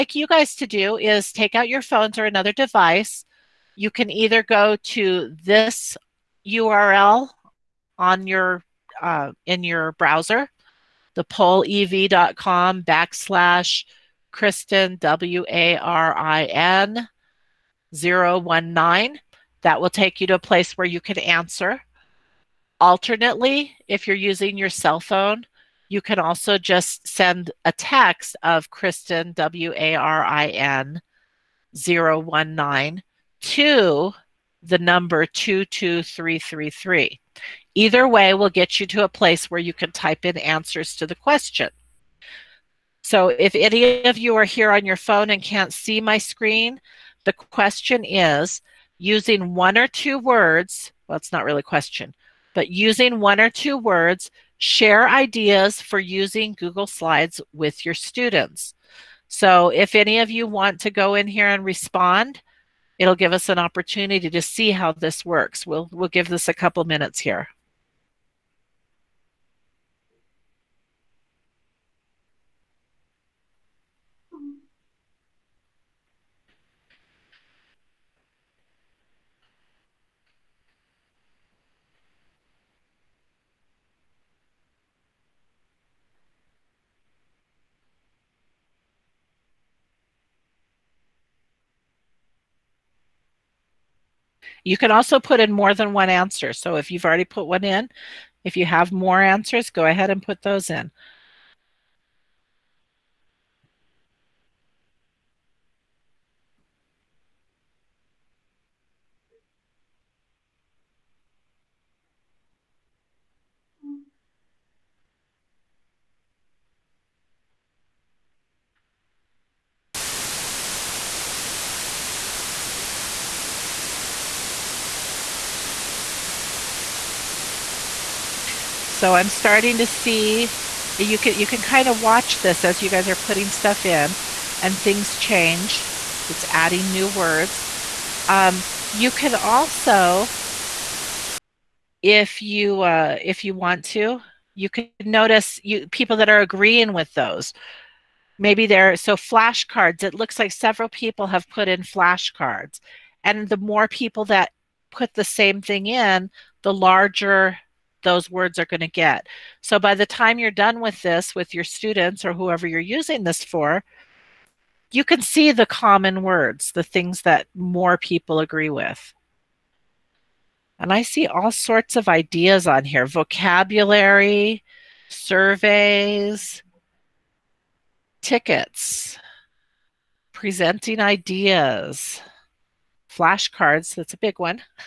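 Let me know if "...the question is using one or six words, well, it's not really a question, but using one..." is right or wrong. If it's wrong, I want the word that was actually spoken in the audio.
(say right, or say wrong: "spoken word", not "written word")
wrong: "two", not "six".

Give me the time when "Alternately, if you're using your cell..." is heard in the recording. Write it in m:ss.
0:22.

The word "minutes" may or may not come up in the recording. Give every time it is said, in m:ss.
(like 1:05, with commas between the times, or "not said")
1:06.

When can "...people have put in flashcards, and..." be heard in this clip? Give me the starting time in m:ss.
2:30.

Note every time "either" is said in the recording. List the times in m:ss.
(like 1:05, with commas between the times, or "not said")
0:04, 0:37.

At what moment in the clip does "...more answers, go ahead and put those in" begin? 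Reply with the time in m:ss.
1:38.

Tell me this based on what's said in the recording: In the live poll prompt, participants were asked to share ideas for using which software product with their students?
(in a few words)
Google Slides.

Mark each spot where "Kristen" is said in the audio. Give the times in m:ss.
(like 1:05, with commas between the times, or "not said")
0:14, 0:28.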